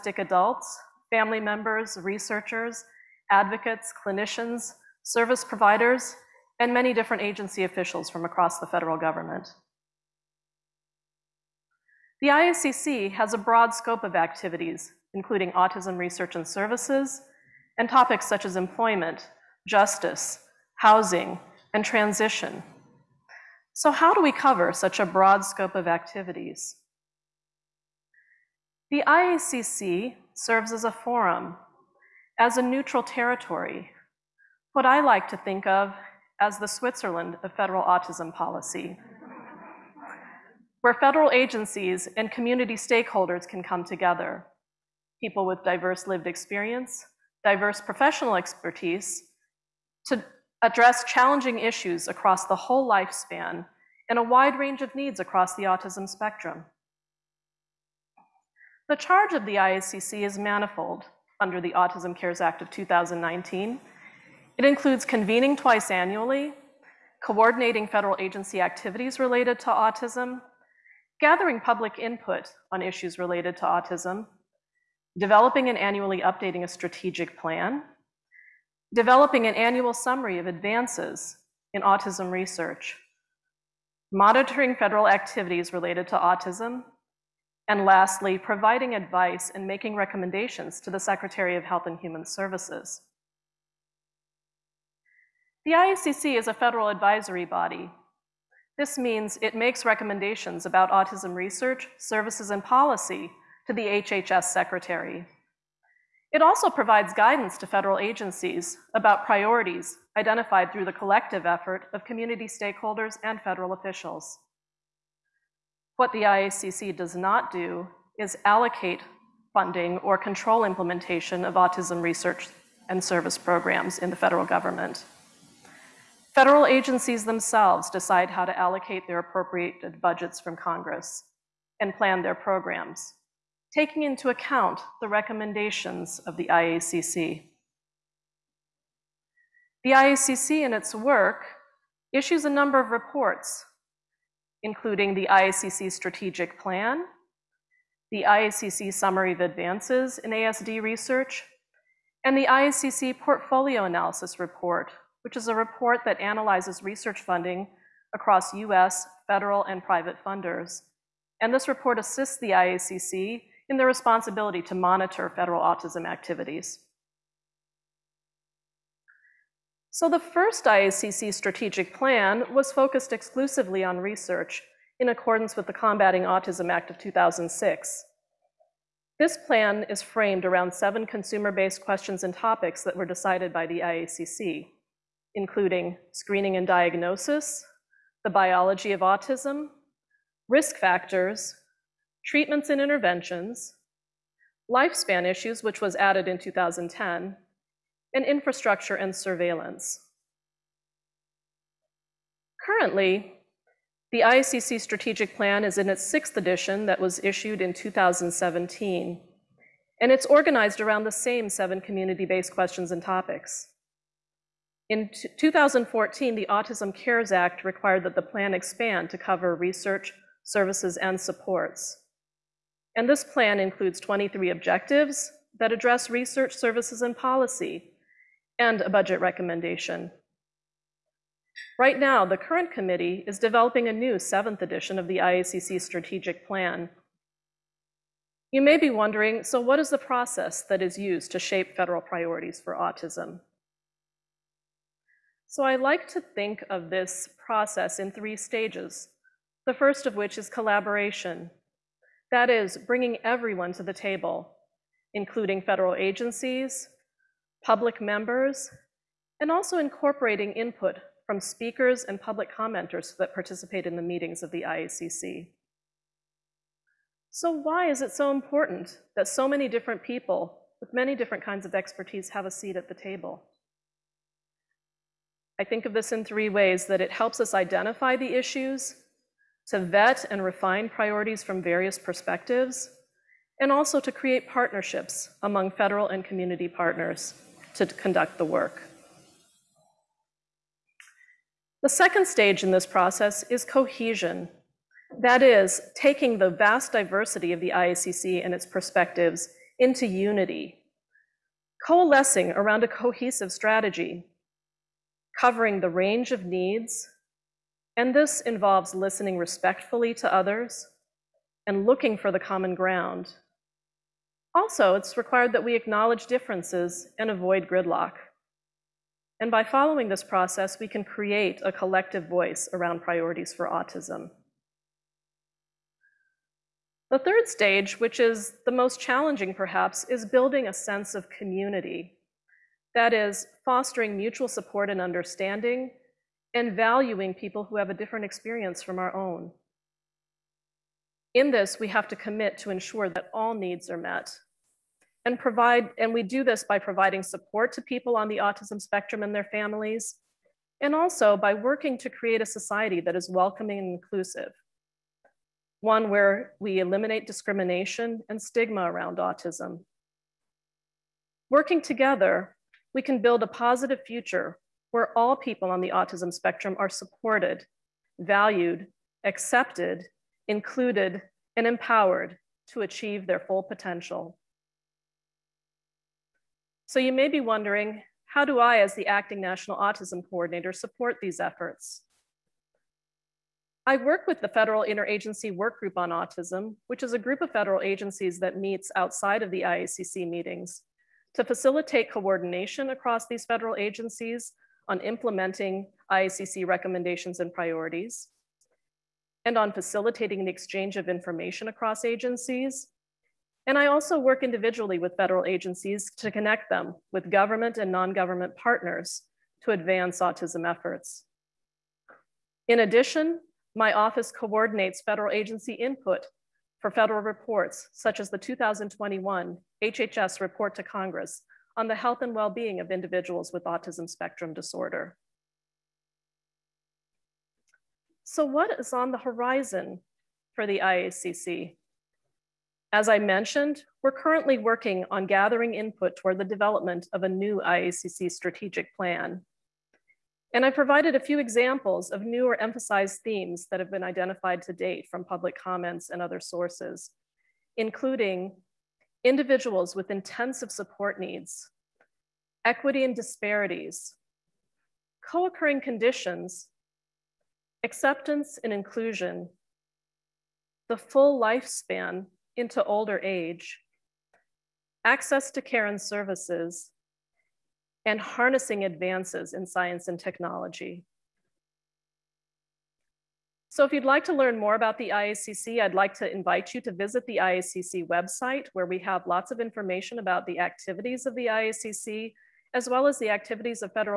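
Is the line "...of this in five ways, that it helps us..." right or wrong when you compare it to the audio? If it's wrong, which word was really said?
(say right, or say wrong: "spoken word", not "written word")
wrong: "three", not "five".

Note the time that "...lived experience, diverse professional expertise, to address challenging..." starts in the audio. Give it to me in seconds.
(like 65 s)
46 s.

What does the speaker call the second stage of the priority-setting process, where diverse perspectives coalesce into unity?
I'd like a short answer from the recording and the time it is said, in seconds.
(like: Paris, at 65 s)
cohesion, at 293 s.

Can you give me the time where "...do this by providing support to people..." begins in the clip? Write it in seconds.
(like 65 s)
346 s.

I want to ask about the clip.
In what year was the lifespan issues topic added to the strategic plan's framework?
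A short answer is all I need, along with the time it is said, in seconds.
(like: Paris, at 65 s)
2010, at 196 s.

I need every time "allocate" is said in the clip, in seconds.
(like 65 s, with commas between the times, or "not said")
118 s, 128 s.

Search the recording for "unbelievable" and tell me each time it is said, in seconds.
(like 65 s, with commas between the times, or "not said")
not said.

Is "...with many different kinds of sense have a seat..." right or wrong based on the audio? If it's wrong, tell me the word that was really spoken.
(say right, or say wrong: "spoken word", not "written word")
wrong: "expertise", not "sense".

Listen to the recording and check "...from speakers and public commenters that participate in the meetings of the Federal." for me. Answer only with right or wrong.
wrong.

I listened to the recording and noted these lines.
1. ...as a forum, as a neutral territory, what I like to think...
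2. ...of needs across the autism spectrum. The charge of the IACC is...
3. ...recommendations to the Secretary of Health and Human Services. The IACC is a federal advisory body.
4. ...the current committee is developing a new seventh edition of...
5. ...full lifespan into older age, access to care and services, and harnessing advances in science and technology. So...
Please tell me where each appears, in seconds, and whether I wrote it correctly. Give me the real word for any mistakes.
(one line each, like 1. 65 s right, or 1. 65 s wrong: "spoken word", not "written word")
1. 30 s right
2. 54 s right
3. 89 s right
4. 232 s right
5. 460 s right.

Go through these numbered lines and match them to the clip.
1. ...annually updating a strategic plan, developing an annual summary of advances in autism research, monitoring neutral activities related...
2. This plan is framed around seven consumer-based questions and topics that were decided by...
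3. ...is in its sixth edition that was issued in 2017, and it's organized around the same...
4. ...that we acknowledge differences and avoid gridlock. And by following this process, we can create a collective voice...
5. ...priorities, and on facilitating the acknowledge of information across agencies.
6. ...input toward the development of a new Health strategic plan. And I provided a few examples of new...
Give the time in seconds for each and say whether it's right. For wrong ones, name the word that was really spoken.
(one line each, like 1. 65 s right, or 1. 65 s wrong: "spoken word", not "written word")
1. 75 s wrong: "federal", not "neutral"
2. 179 s right
3. 205 s right
4. 315 s right
5. 397 s wrong: "exchange", not "acknowledge"
6. 435 s wrong: "IACC", not "Health".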